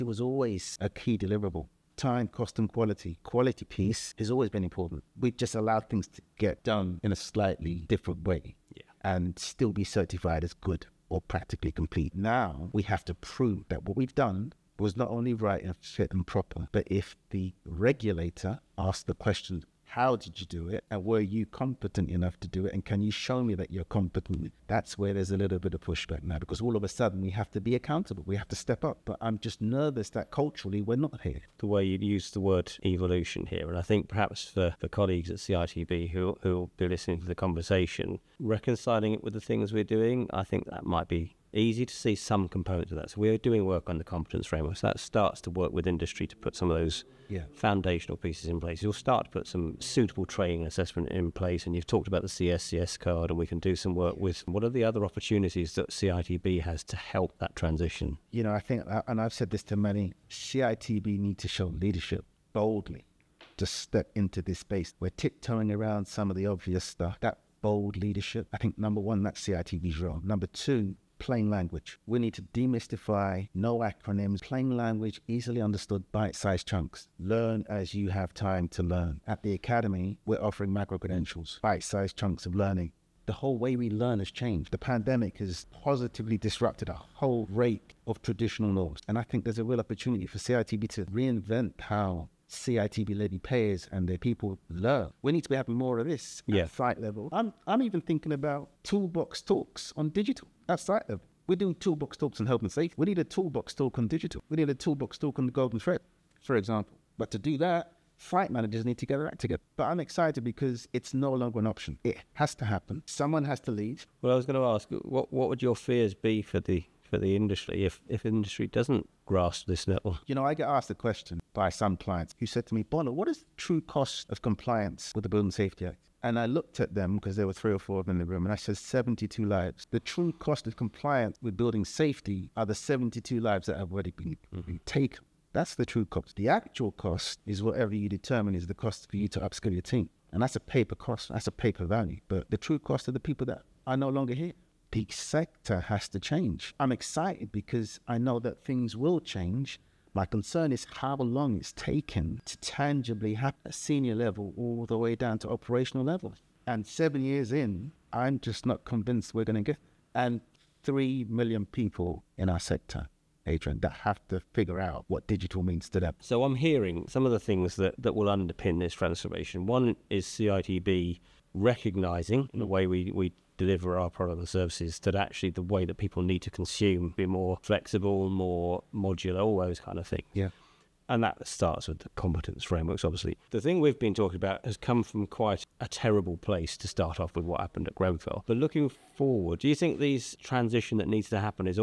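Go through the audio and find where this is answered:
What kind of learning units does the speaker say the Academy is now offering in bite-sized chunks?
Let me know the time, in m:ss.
1:20.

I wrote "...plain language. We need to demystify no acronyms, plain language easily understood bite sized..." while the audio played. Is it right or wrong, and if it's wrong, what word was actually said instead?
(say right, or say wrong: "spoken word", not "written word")
right.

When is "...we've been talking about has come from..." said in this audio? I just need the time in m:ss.
3:03.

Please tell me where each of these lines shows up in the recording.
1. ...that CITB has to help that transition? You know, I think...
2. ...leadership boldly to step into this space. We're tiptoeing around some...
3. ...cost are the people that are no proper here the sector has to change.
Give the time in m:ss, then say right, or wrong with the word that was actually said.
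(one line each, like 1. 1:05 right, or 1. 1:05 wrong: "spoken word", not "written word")
1. 0:55 right
2. 1:01 right
3. 2:22 wrong: "longer", not "proper".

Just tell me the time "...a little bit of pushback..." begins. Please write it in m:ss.
0:25.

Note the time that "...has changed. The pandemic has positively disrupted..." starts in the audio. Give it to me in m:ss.
1:24.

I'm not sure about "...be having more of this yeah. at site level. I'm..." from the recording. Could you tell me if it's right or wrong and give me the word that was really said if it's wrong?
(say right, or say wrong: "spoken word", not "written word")
right.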